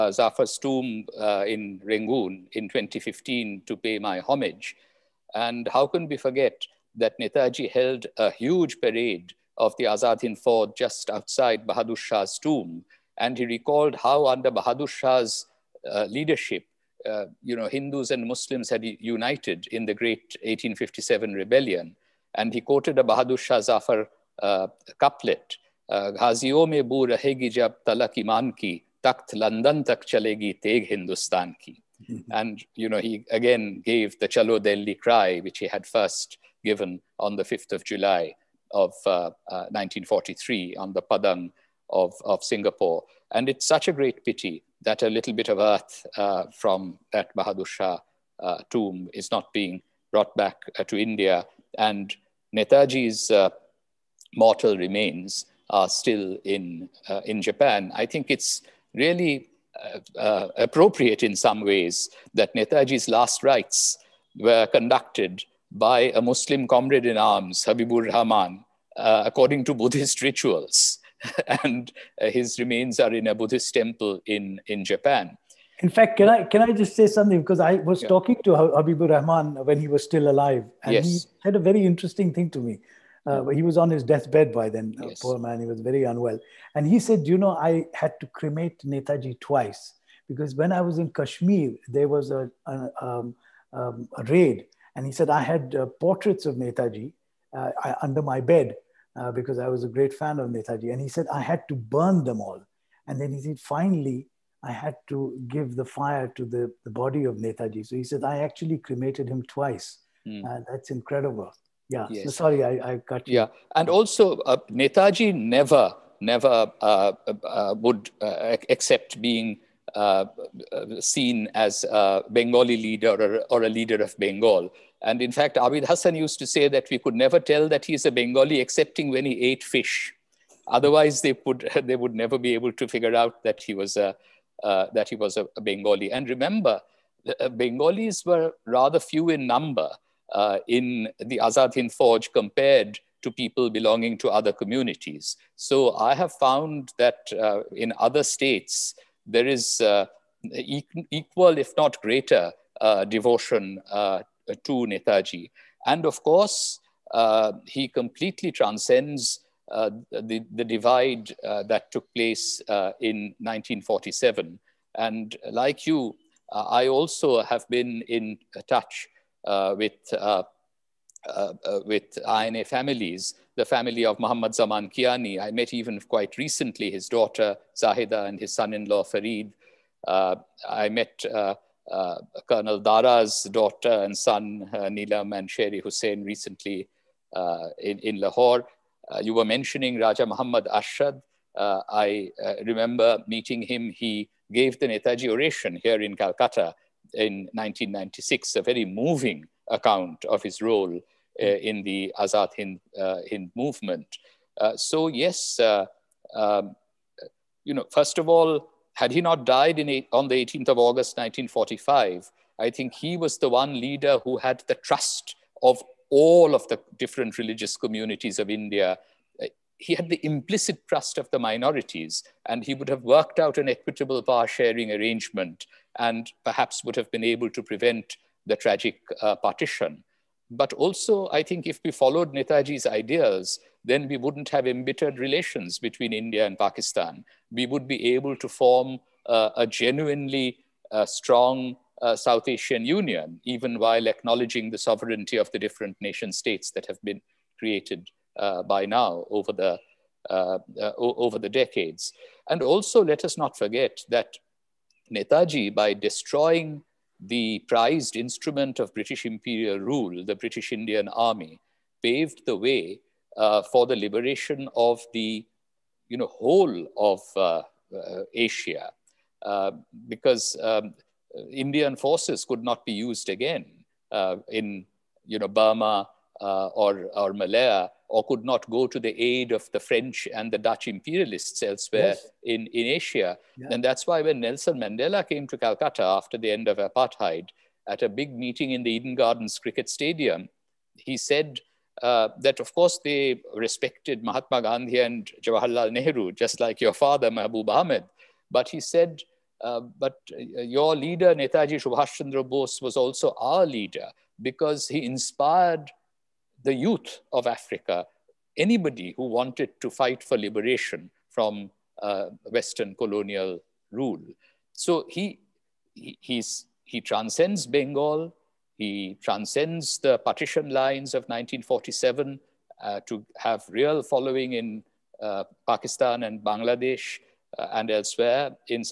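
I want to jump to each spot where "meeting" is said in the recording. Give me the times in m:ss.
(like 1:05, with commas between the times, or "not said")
3:13, 4:48.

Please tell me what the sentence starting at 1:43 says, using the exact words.
And then he said, Finally, I had to give the fire to the, the body of Netaji.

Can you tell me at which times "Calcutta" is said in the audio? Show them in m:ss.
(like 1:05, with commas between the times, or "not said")
3:16, 4:45.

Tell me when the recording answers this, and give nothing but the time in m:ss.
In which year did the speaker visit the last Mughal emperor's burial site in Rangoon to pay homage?
0:02.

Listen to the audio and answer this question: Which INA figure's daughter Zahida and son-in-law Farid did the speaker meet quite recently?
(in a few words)
Muhammad Zaman Kiani.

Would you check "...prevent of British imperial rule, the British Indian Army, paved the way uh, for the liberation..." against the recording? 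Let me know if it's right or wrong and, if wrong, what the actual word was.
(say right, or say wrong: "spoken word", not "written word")
wrong: "instrument", not "prevent".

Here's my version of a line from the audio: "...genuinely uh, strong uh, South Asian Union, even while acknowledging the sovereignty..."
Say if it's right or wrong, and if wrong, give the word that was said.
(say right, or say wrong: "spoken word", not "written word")
right.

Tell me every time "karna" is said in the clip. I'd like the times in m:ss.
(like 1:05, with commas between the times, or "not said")
not said.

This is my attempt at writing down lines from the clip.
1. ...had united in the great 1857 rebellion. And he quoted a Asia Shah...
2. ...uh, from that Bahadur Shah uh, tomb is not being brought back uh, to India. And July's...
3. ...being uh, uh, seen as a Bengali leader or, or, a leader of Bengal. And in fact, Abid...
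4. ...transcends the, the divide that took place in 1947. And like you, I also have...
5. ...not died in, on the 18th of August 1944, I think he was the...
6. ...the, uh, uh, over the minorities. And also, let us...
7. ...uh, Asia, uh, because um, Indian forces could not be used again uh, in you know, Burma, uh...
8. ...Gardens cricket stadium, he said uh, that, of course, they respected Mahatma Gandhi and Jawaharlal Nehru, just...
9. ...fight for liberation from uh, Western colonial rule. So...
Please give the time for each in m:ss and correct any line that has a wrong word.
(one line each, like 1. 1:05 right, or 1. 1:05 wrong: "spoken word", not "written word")
1. 0:18 wrong: "Bahadur", not "Asia"
2. 0:46 wrong: "Netaji", not "July"
3. 1:59 right
4. 2:38 right
5. 3:29 wrong: "1945", not "1944"
6. 4:09 wrong: "decades", not "minorities"
7. 4:27 right
8. 4:49 right
9. 5:09 right.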